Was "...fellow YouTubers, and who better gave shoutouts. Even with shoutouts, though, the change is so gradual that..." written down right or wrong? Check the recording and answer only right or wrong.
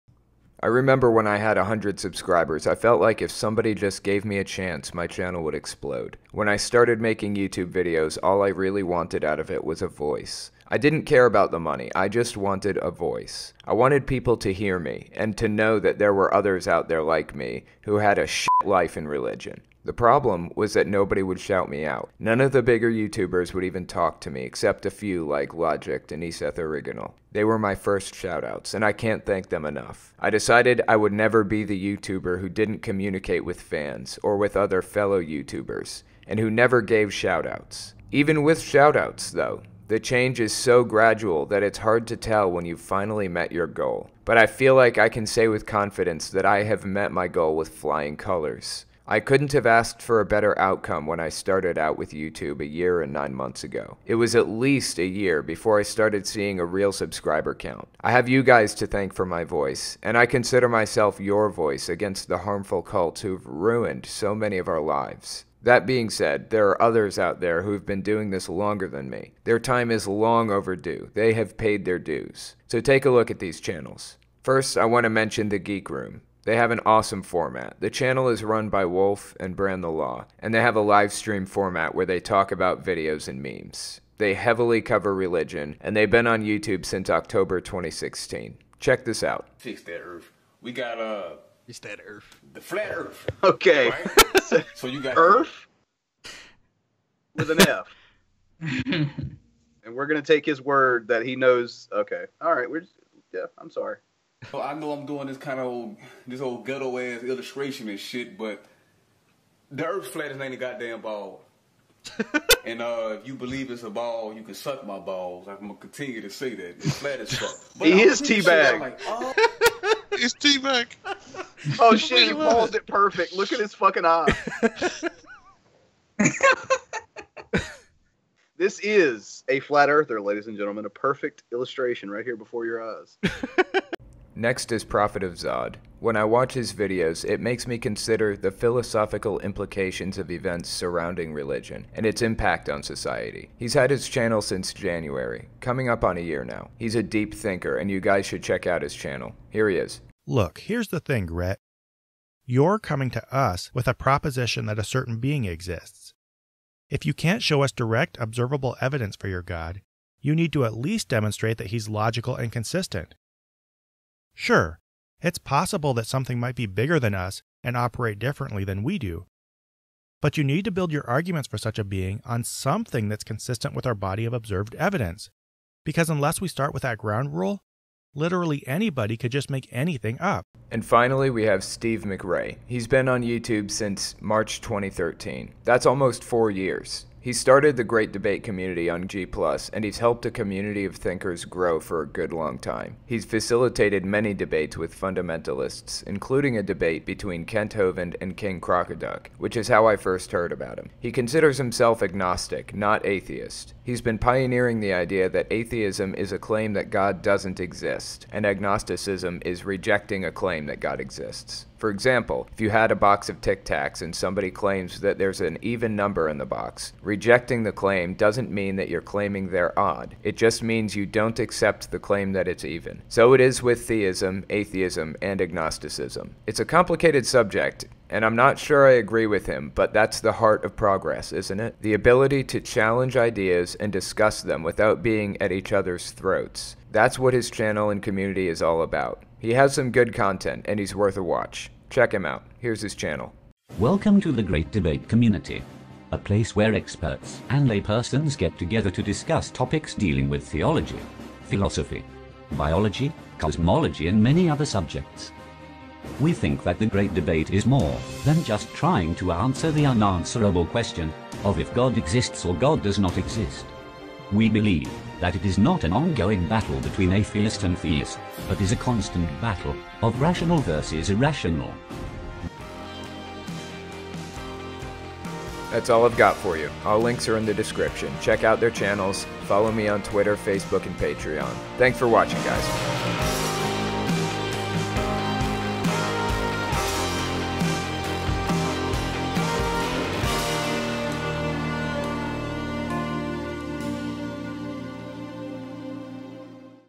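wrong.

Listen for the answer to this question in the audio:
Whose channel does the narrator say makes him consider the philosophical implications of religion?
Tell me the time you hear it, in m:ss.
2:14.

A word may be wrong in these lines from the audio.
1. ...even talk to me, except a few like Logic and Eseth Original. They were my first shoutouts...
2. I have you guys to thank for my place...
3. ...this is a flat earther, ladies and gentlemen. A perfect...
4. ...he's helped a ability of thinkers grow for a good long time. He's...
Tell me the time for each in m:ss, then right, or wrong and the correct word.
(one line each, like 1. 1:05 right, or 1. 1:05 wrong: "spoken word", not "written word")
1. 0:23 right
2. 0:57 wrong: "voice", not "place"
3. 2:08 right
4. 3:09 wrong: "community", not "ability".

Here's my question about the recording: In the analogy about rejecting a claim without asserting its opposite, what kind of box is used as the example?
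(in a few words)
a box of Tic Tacs.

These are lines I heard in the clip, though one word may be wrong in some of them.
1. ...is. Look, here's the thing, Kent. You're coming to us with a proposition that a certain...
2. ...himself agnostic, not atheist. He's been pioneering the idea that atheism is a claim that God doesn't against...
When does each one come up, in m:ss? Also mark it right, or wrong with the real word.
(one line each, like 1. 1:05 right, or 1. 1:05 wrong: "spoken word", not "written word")
1. 2:29 wrong: "Rhett", not "Kent"
2. 3:21 wrong: "exist", not "against".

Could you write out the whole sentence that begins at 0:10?
I didn't care about the money.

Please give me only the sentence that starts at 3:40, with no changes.
It just means you don't accept the claim that it's even.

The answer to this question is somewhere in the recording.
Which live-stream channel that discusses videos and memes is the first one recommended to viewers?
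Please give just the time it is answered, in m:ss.
1:15.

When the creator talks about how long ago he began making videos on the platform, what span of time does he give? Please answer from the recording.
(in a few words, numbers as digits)
a year and nine months.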